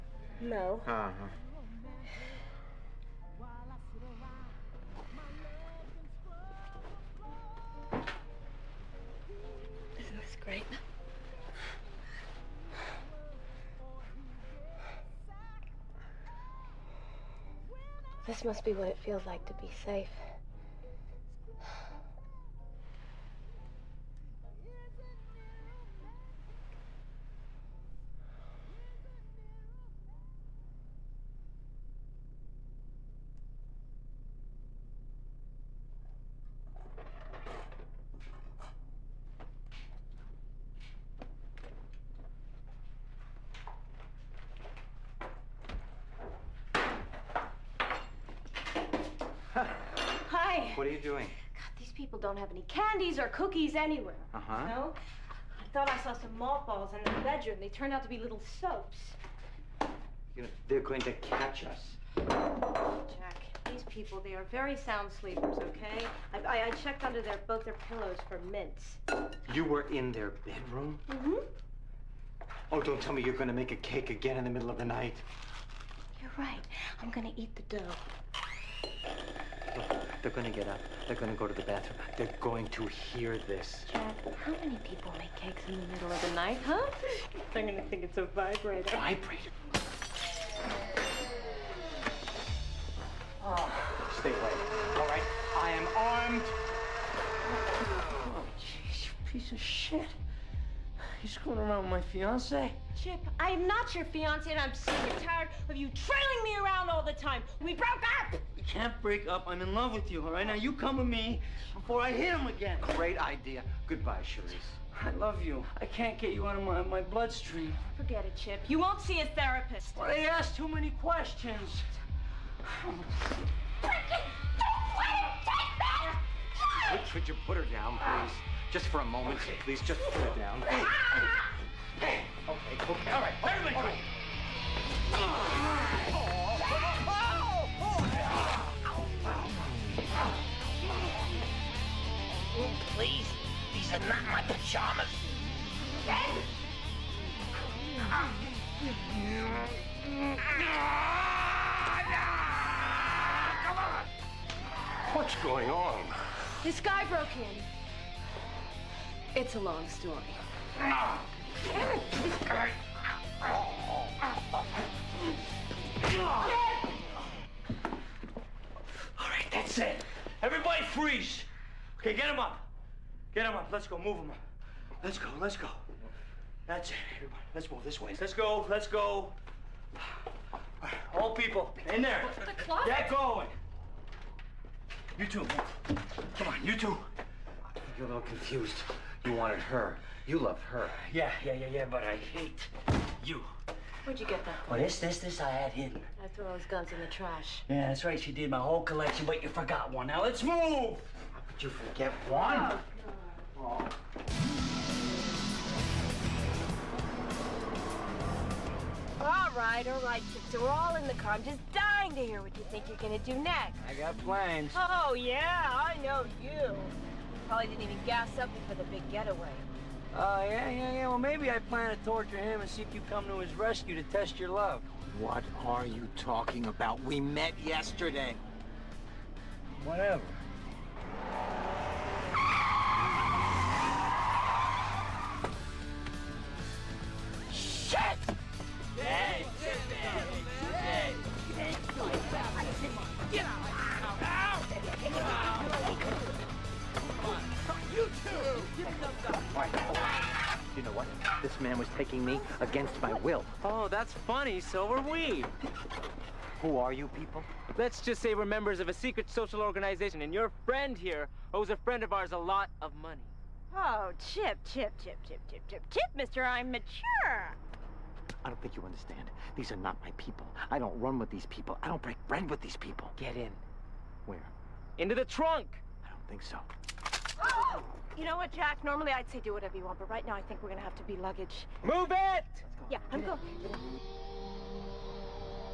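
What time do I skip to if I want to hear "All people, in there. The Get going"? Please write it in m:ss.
3:01.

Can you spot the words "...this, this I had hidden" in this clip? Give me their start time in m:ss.
3:15.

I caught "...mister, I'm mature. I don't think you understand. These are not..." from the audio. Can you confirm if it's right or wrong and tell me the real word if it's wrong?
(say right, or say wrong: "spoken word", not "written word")
right.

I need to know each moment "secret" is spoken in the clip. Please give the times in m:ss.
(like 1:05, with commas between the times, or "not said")
4:18.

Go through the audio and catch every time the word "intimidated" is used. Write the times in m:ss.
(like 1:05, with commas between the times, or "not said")
not said.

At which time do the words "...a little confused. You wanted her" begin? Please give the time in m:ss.
3:08.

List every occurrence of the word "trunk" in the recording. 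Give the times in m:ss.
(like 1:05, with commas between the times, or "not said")
4:35.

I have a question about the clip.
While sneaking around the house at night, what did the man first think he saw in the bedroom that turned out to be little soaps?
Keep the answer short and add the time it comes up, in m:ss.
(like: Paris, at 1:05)
Mothballs, at 0:56.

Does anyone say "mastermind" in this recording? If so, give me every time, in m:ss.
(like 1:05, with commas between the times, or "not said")
not said.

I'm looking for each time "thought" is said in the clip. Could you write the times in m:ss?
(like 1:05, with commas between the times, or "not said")
0:55.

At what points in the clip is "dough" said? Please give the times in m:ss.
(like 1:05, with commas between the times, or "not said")
1:17.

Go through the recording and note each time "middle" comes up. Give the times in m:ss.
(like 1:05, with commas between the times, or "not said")
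1:14, 1:25.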